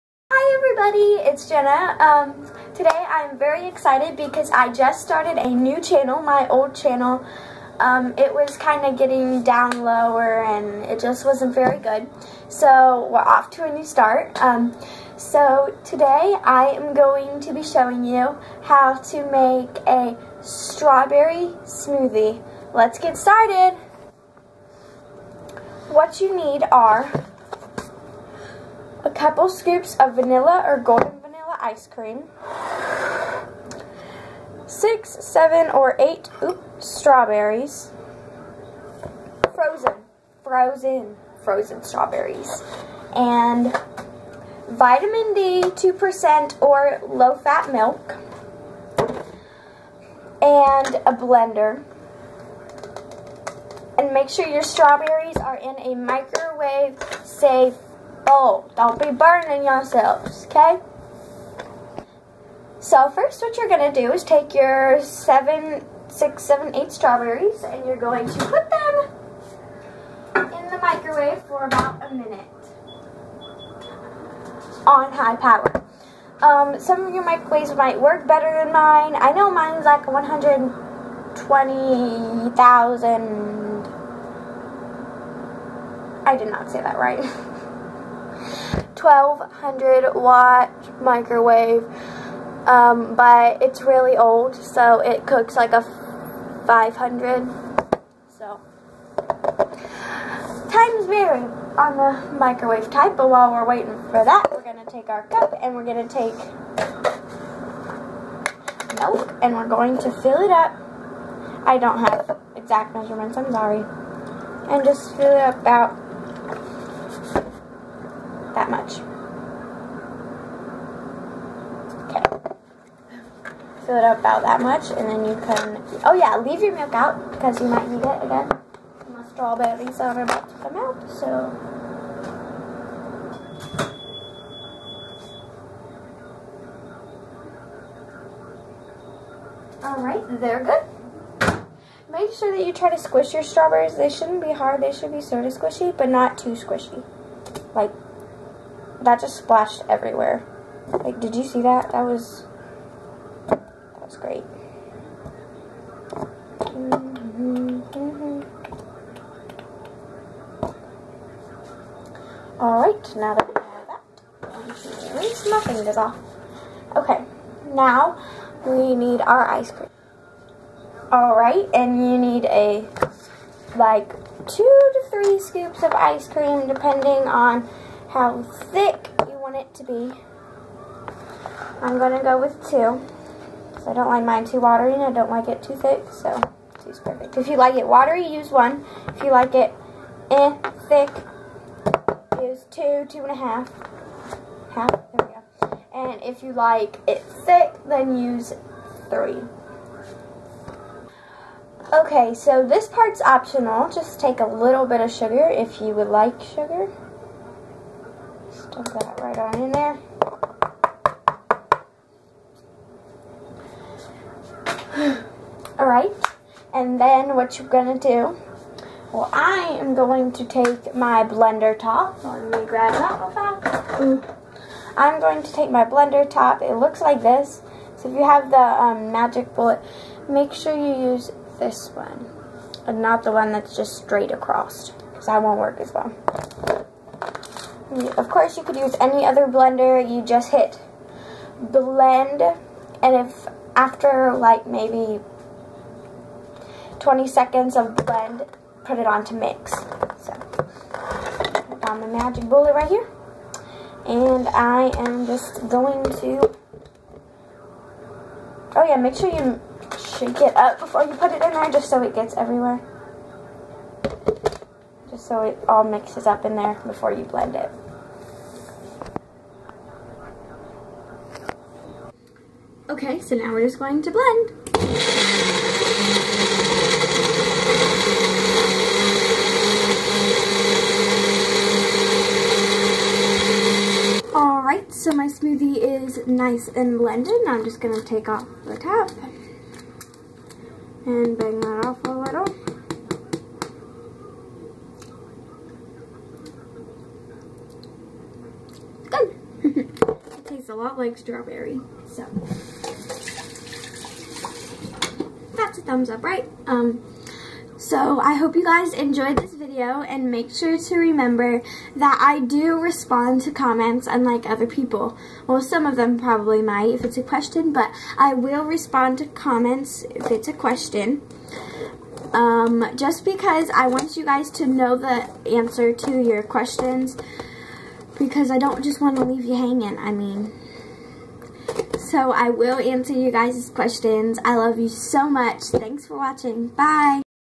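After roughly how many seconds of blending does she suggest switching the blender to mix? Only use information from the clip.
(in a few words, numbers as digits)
20 seconds.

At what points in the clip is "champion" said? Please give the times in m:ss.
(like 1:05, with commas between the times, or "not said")
not said.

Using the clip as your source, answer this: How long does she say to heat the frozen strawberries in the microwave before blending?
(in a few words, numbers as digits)
About a minute.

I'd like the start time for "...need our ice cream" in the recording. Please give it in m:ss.
2:48.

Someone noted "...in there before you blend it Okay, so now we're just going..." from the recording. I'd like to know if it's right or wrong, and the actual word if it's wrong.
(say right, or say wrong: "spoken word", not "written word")
right.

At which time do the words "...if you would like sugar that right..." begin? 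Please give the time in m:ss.
3:25.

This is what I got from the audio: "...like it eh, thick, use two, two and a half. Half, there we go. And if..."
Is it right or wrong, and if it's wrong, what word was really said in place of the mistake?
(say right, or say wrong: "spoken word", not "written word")
right.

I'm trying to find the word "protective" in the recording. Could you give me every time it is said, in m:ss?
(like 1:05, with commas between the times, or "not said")
not said.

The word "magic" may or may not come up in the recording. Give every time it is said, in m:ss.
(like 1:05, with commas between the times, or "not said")
3:49, 4:12.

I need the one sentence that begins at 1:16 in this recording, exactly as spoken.
Um, some of your microwaves might work better than mine.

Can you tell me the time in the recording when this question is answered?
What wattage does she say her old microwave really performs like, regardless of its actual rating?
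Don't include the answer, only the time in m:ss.
1:35.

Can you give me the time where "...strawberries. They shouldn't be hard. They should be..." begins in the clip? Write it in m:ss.
2:23.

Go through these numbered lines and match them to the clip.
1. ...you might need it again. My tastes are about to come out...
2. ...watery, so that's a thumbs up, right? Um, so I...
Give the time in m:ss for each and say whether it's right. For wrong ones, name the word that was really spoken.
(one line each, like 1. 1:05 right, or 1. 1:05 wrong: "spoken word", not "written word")
1. 2:07 wrong: "strawberries", not "tastes"
2. 5:01 wrong: "strawberry", not "watery".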